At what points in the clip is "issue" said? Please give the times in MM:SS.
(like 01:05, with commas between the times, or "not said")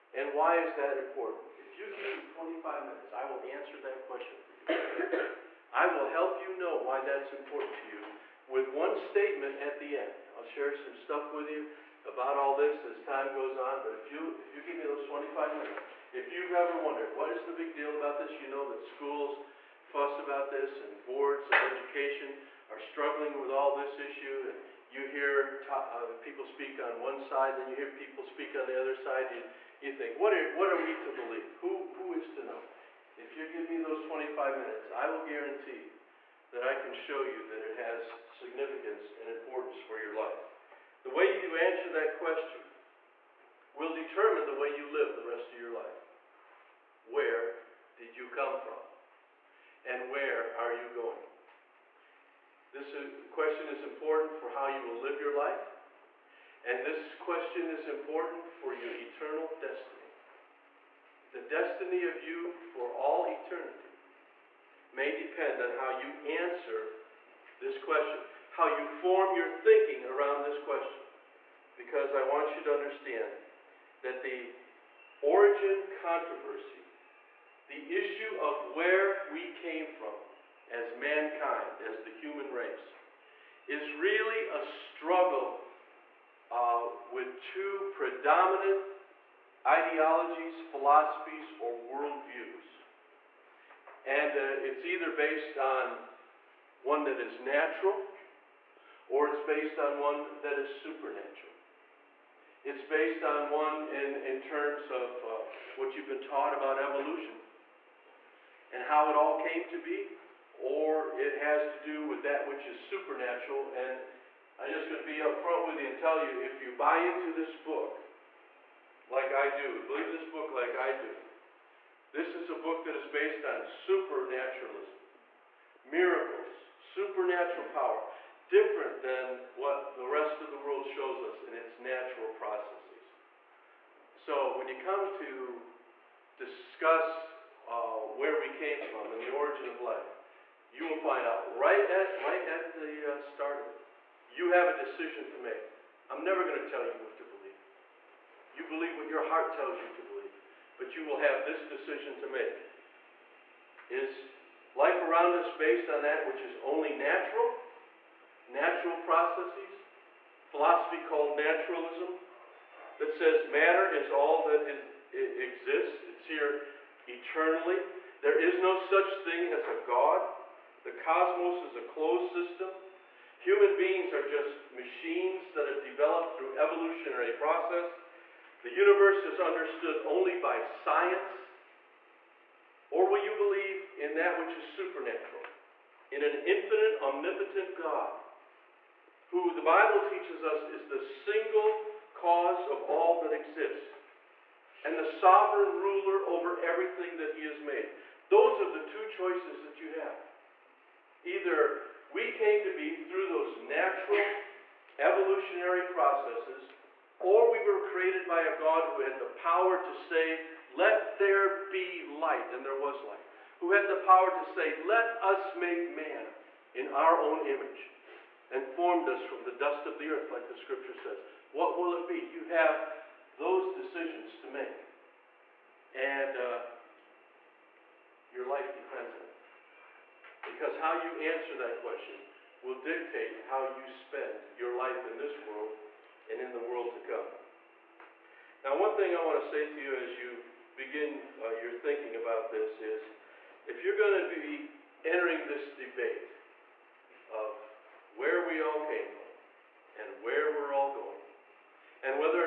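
00:23, 01:17.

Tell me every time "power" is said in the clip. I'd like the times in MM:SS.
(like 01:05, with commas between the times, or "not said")
02:07, 03:29, 03:33.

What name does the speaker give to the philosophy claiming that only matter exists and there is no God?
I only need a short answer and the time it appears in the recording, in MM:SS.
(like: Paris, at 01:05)
naturalism, at 02:41.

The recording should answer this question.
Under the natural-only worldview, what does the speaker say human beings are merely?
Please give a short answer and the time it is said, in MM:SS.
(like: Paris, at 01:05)
machines, at 02:54.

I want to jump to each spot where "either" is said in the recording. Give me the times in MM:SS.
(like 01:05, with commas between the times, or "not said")
01:34, 03:21.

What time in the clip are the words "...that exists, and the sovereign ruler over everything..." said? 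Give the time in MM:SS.
03:13.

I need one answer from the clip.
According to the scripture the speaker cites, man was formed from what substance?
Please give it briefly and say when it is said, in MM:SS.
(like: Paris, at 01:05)
dust of the earth, at 03:39.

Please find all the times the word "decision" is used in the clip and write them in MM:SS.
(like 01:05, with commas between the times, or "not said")
02:24, 02:31, 03:43.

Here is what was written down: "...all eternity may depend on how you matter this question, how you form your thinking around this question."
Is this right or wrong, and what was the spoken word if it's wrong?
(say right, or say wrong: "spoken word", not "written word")
wrong: "answer", not "matter".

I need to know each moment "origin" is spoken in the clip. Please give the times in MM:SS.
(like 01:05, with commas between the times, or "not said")
01:15, 02:19.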